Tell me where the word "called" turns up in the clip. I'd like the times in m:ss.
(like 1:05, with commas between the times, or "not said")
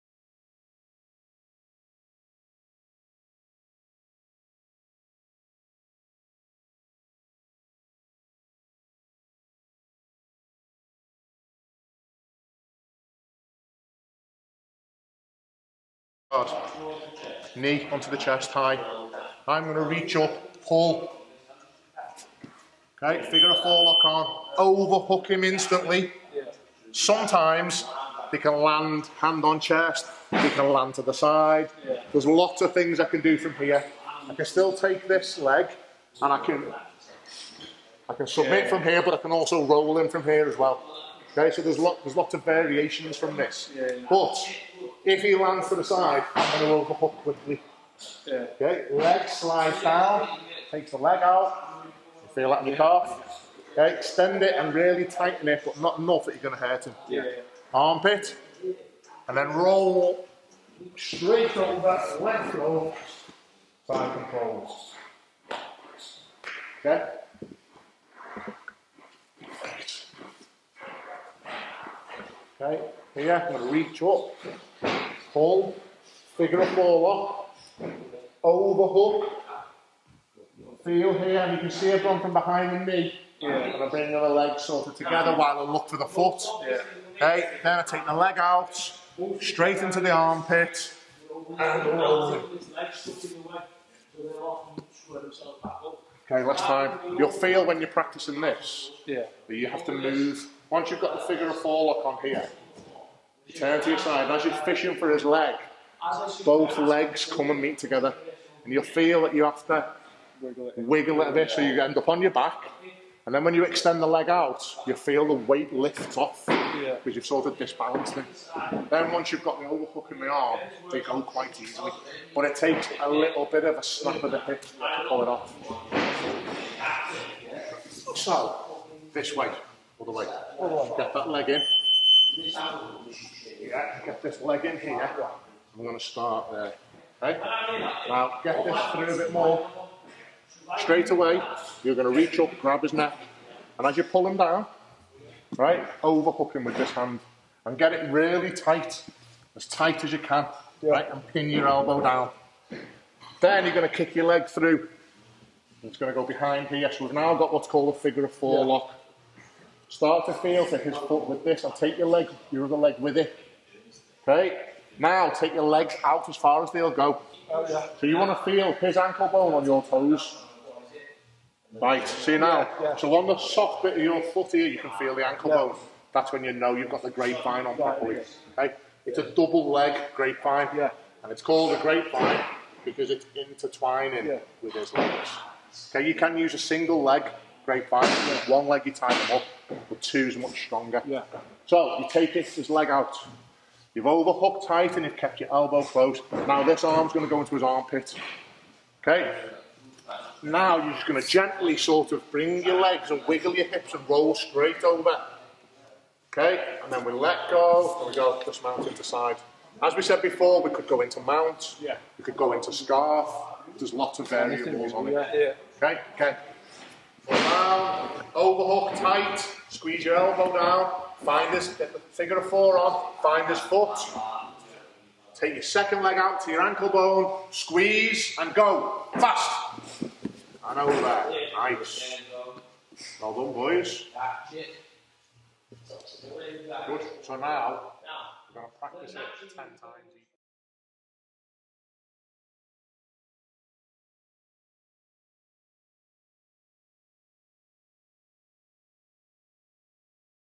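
2:37, 3:01.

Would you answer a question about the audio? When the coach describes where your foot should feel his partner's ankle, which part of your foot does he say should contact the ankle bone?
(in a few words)
soft bit of your foot.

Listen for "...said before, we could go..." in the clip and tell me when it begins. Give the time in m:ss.
3:30.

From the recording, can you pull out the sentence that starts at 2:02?
But it takes a little bit of a snap of the hip to pull it off.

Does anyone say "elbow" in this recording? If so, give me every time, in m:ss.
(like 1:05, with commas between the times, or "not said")
2:31, 3:15, 3:40.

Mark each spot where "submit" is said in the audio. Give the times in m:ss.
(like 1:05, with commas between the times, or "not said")
0:38.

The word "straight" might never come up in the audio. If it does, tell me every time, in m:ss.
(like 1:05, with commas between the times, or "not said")
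1:00, 1:29, 2:20, 3:24.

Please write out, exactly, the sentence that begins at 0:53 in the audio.
Okay, extend it and really tighten it, but not enough that you're going to hurt him.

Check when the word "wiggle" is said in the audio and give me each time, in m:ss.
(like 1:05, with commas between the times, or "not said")
1:50, 3:23.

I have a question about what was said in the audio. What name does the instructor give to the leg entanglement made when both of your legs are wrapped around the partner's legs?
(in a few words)
double leg grapevine.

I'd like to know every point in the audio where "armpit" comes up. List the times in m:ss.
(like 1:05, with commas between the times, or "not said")
0:57, 1:30, 3:17.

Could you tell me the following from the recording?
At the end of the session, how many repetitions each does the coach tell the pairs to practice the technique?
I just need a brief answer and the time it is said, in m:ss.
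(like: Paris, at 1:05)
10, at 3:59.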